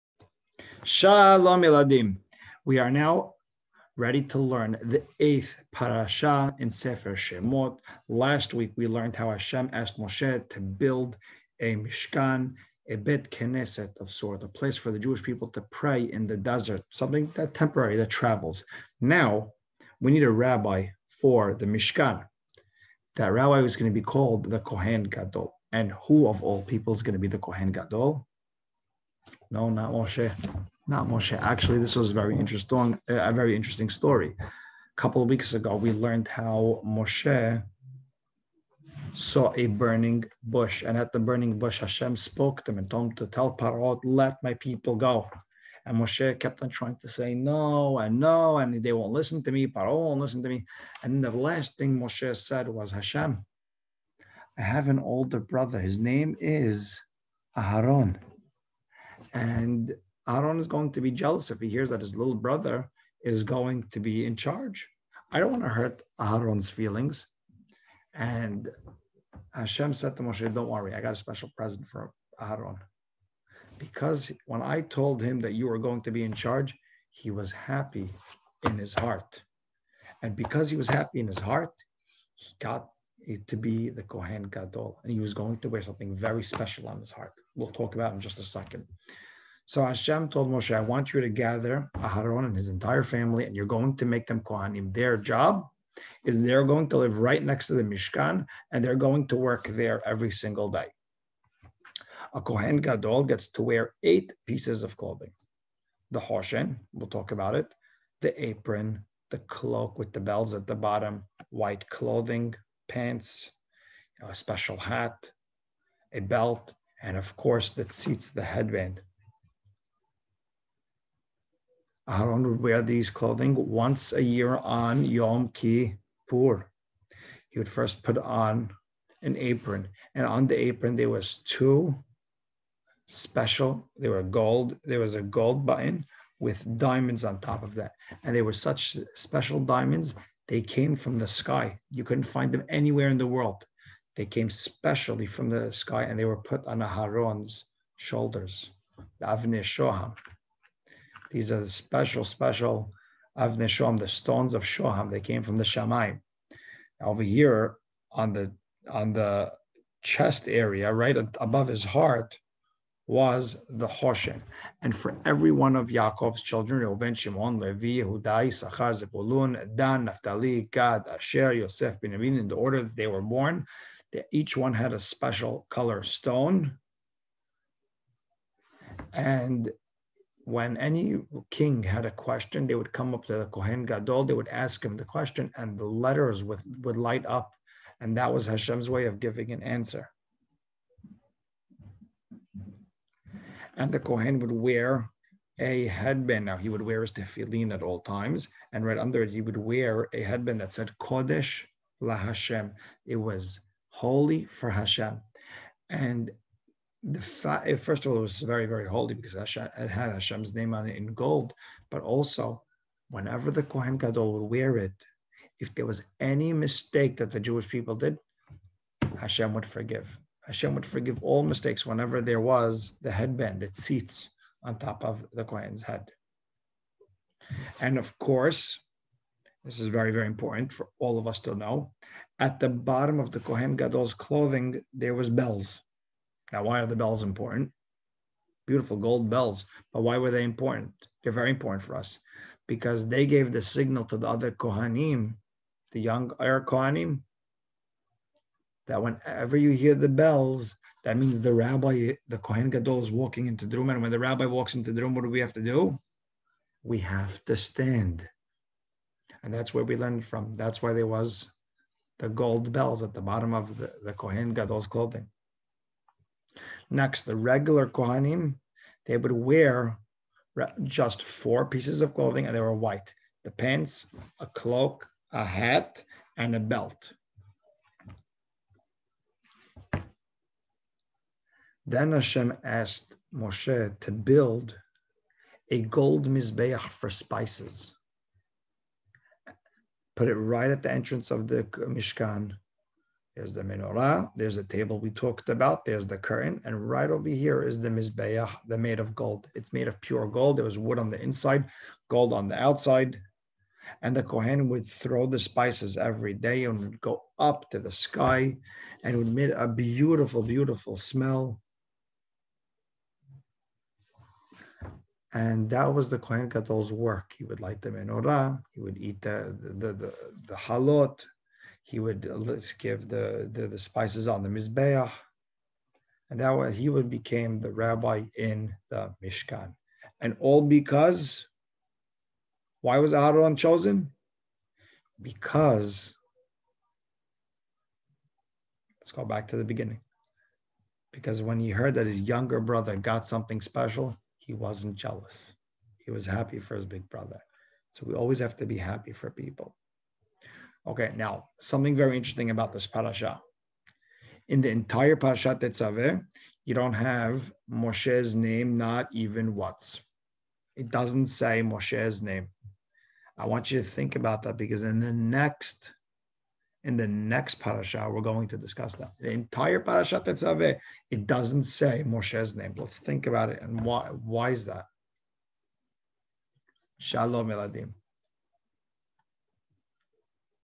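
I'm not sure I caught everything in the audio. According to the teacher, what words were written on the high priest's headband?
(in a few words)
Kodesh La Hashem.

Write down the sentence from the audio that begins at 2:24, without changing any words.
They came specially from the sky and they were put on Aharon's shoulders, the Avnei Shoham.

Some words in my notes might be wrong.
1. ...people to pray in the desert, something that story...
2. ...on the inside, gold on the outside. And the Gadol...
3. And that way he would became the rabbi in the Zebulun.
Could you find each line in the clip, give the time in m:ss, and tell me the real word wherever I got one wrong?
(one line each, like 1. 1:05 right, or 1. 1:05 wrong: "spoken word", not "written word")
1. 0:15 wrong: "temporary", not "story"
2. 5:00 wrong: "Kohen", not "Gadol"
3. 5:26 wrong: "Mishkan", not "Zebulun".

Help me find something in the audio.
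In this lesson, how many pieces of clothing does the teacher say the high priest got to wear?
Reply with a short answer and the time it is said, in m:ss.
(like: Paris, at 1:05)
8, at 1:44.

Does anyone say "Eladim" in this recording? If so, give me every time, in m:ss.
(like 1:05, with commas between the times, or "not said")
0:01, 6:17.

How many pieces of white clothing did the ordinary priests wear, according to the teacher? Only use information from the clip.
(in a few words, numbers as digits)
4.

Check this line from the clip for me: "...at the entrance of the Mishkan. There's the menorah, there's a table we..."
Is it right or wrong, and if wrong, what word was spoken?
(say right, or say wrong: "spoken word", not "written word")
right.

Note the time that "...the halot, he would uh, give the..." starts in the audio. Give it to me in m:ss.
5:20.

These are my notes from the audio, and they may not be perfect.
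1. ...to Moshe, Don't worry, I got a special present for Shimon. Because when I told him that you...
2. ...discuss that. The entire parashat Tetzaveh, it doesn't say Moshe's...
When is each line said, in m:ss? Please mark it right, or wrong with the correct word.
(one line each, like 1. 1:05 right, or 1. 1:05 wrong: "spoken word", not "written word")
1. 1:10 wrong: "Aaron", not "Shimon"
2. 6:08 right.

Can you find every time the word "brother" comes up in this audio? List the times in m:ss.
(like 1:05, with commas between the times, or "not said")
0:55, 1:02, 5:42, 5:47.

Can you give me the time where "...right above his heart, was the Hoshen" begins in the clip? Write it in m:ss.
2:40.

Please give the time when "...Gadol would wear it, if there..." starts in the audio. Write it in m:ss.
3:33.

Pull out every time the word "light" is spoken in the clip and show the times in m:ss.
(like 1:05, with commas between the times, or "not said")
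3:06, 5:17.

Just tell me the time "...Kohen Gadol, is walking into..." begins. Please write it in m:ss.
4:12.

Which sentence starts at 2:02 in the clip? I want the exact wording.
Aaron would wear these clothing once a year on Yom Kippur.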